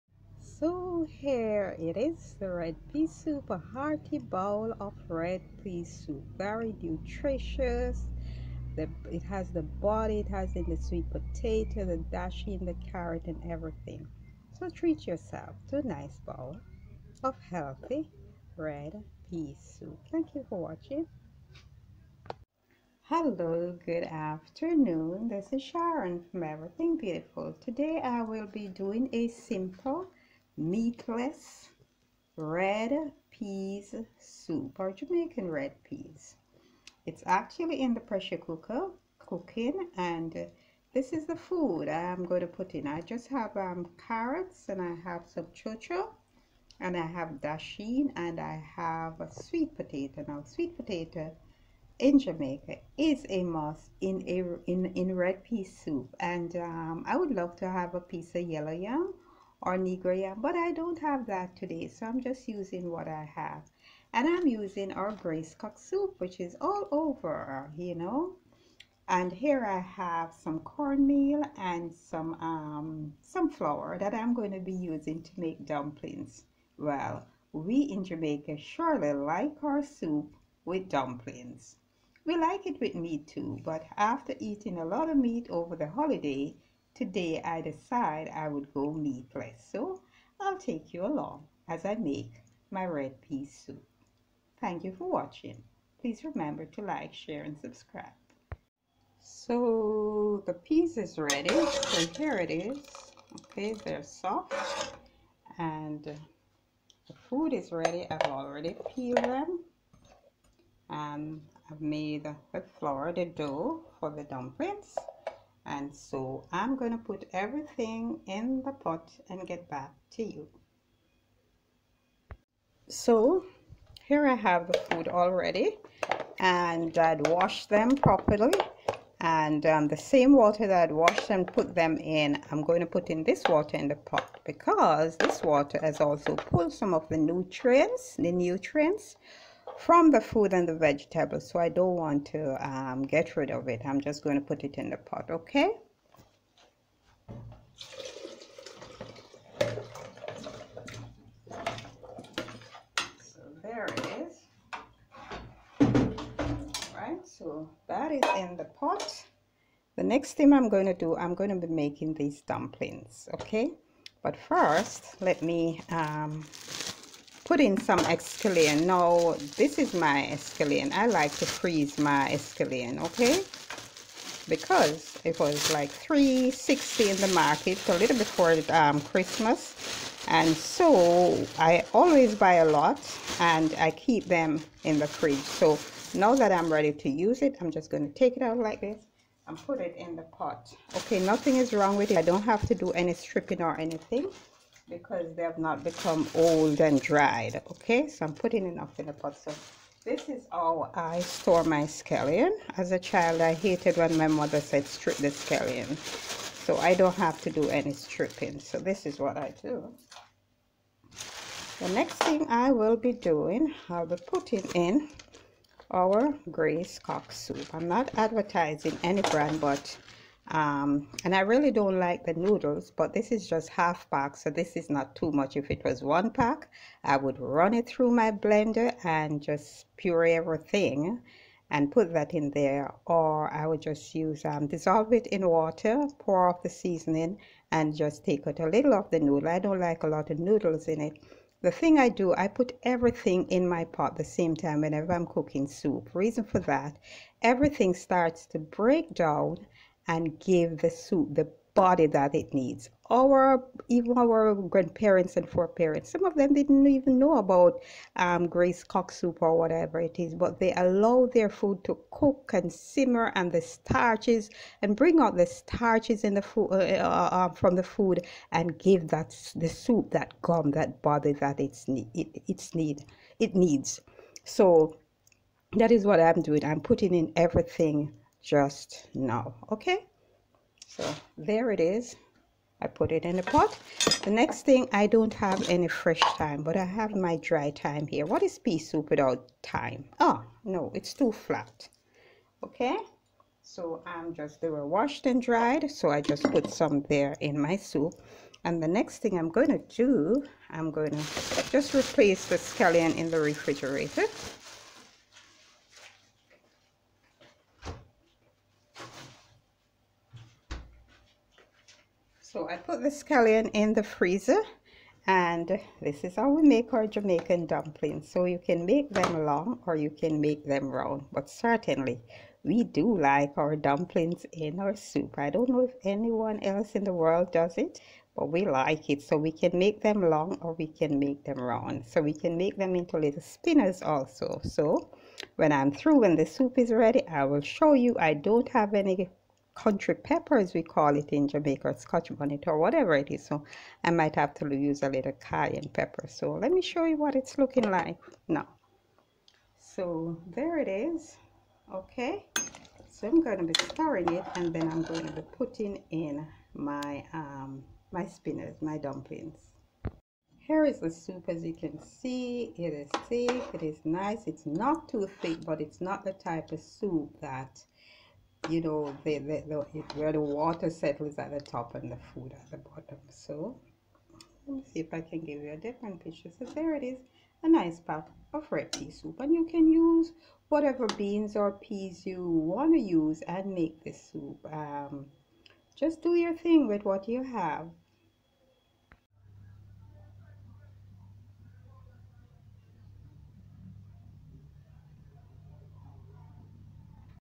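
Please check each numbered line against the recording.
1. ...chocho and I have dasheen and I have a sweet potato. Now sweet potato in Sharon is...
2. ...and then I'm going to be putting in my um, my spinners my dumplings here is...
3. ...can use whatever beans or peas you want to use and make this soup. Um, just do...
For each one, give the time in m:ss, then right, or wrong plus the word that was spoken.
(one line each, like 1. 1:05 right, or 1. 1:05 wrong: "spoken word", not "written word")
1. 0:45 wrong: "Jamaica", not "Sharon"
2. 5:54 right
3. 6:19 right.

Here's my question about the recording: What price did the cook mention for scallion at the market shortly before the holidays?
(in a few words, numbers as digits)
360.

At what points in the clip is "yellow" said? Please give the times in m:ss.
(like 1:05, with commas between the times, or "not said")
0:58.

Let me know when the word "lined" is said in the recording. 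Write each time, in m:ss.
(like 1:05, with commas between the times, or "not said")
not said.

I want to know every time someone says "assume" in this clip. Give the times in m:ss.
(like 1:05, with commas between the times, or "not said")
not said.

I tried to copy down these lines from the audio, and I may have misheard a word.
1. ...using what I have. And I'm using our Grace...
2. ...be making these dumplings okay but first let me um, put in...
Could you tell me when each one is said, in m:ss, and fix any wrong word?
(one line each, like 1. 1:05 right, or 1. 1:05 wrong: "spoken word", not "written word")
1. 1:02 right
2. 2:41 right.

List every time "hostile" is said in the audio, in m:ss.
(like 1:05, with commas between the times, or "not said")
not said.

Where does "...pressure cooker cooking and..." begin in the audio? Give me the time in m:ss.
0:38.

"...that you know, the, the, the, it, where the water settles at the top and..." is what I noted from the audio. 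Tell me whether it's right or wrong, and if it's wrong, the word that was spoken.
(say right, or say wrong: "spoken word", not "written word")
right.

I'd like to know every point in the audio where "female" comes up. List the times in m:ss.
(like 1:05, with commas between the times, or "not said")
not said.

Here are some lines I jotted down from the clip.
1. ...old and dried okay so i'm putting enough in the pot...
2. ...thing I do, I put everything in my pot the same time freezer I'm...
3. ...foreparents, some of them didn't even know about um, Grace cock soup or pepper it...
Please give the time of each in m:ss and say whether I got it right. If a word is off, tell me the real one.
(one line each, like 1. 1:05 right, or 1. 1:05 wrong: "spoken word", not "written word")
1. 3:16 right
2. 4:01 wrong: "whenever", not "freezer"
3. 4:15 wrong: "whatever", not "pepper".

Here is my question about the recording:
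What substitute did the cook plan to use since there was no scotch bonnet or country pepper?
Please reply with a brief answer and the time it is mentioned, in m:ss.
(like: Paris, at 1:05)
Cayenne pepper, at 5:45.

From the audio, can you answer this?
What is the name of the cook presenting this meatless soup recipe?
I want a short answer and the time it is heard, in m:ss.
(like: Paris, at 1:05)
Sharon, at 0:25.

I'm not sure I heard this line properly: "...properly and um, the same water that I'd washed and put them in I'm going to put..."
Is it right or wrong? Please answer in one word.
right.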